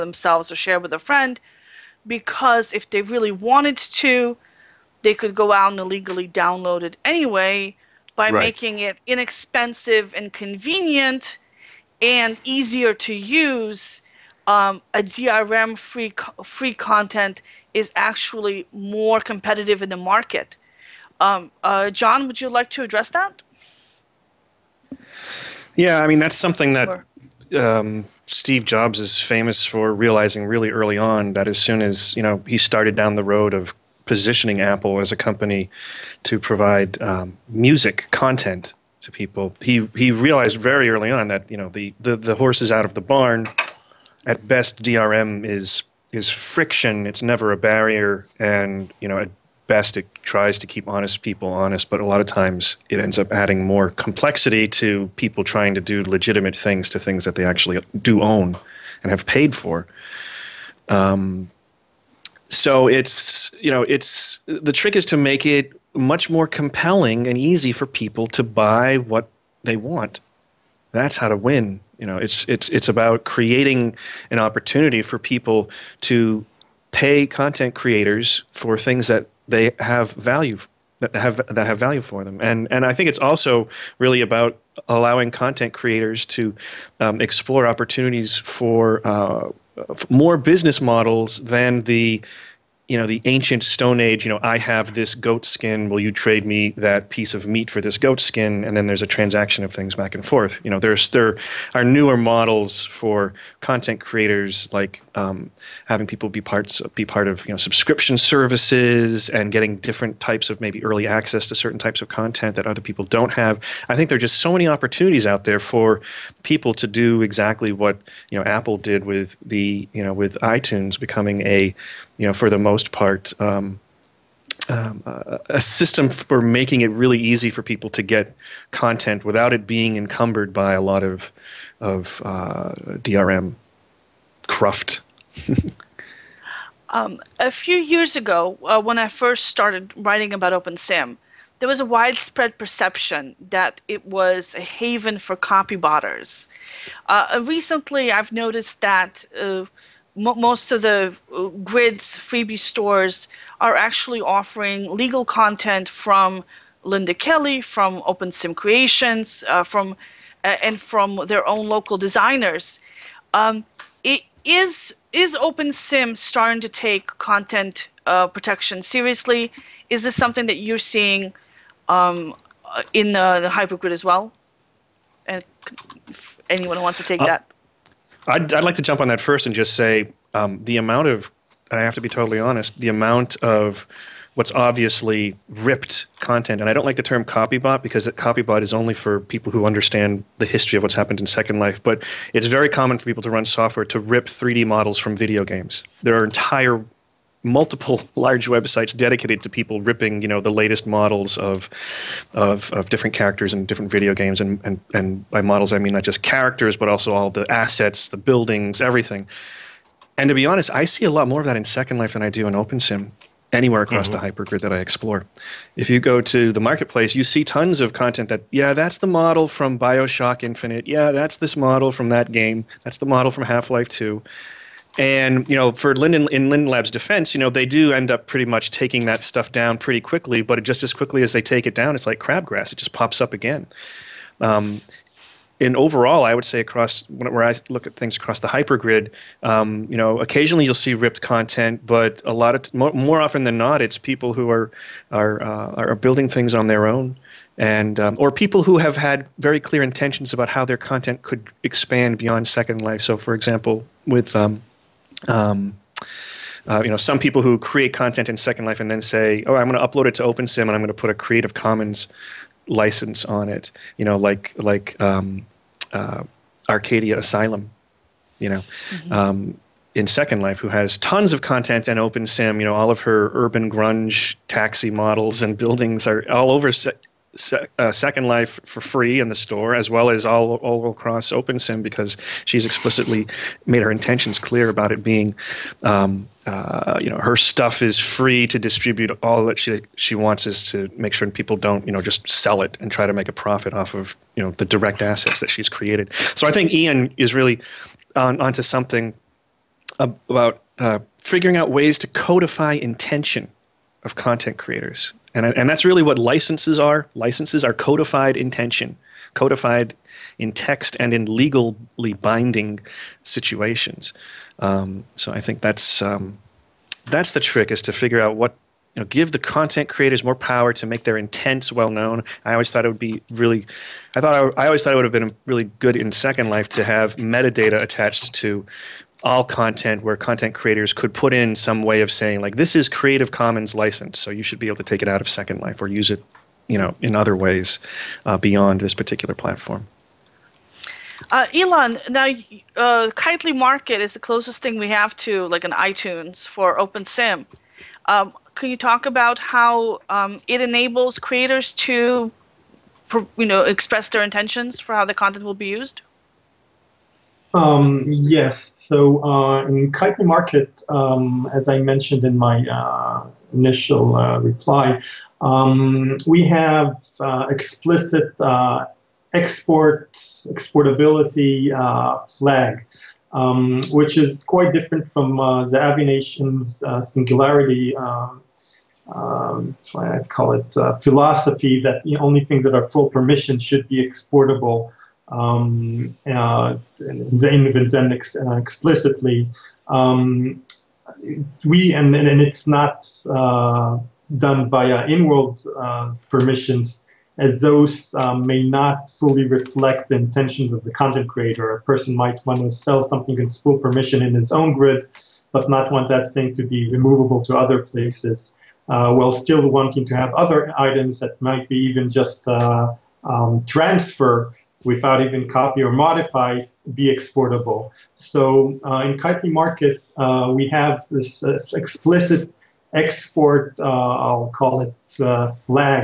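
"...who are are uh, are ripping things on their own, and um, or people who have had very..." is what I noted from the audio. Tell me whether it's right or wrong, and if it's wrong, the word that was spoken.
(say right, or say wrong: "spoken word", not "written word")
wrong: "building", not "ripping".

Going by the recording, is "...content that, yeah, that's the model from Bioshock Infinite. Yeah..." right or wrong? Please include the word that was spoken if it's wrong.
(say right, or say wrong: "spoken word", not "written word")
right.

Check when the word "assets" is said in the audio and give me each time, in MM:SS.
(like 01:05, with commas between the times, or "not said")
03:27, 04:55.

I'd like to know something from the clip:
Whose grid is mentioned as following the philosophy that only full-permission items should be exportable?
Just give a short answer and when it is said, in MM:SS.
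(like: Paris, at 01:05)
Avination, at 06:15.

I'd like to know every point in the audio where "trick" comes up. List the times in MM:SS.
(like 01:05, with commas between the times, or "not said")
01:04, 05:17.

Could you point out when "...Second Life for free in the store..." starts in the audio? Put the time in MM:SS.
04:37.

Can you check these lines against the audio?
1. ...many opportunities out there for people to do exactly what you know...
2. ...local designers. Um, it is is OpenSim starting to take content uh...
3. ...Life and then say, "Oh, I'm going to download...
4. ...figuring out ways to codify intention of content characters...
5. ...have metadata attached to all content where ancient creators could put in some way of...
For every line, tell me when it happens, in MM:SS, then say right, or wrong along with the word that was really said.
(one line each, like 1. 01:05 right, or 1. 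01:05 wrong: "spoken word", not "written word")
1. 01:54 right
2. 02:41 right
3. 04:18 wrong: "upload", not "download"
4. 05:01 wrong: "creators", not "characters"
5. 05:26 wrong: "content", not "ancient".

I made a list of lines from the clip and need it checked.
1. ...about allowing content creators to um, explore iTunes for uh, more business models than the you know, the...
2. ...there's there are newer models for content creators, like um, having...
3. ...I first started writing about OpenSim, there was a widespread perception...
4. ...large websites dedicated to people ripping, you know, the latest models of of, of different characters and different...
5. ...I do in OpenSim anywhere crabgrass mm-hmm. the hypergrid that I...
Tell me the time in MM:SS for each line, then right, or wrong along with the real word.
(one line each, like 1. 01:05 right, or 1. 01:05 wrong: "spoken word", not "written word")
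1. 01:24 wrong: "opportunities", not "iTunes"
2. 01:40 right
3. 02:18 right
4. 03:18 right
5. 03:32 wrong: "across", not "crabgrass".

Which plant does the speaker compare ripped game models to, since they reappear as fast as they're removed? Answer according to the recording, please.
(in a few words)
crabgrass.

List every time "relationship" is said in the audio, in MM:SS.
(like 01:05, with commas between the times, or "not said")
not said.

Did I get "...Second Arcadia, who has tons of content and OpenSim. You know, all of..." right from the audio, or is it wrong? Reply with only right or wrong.
wrong.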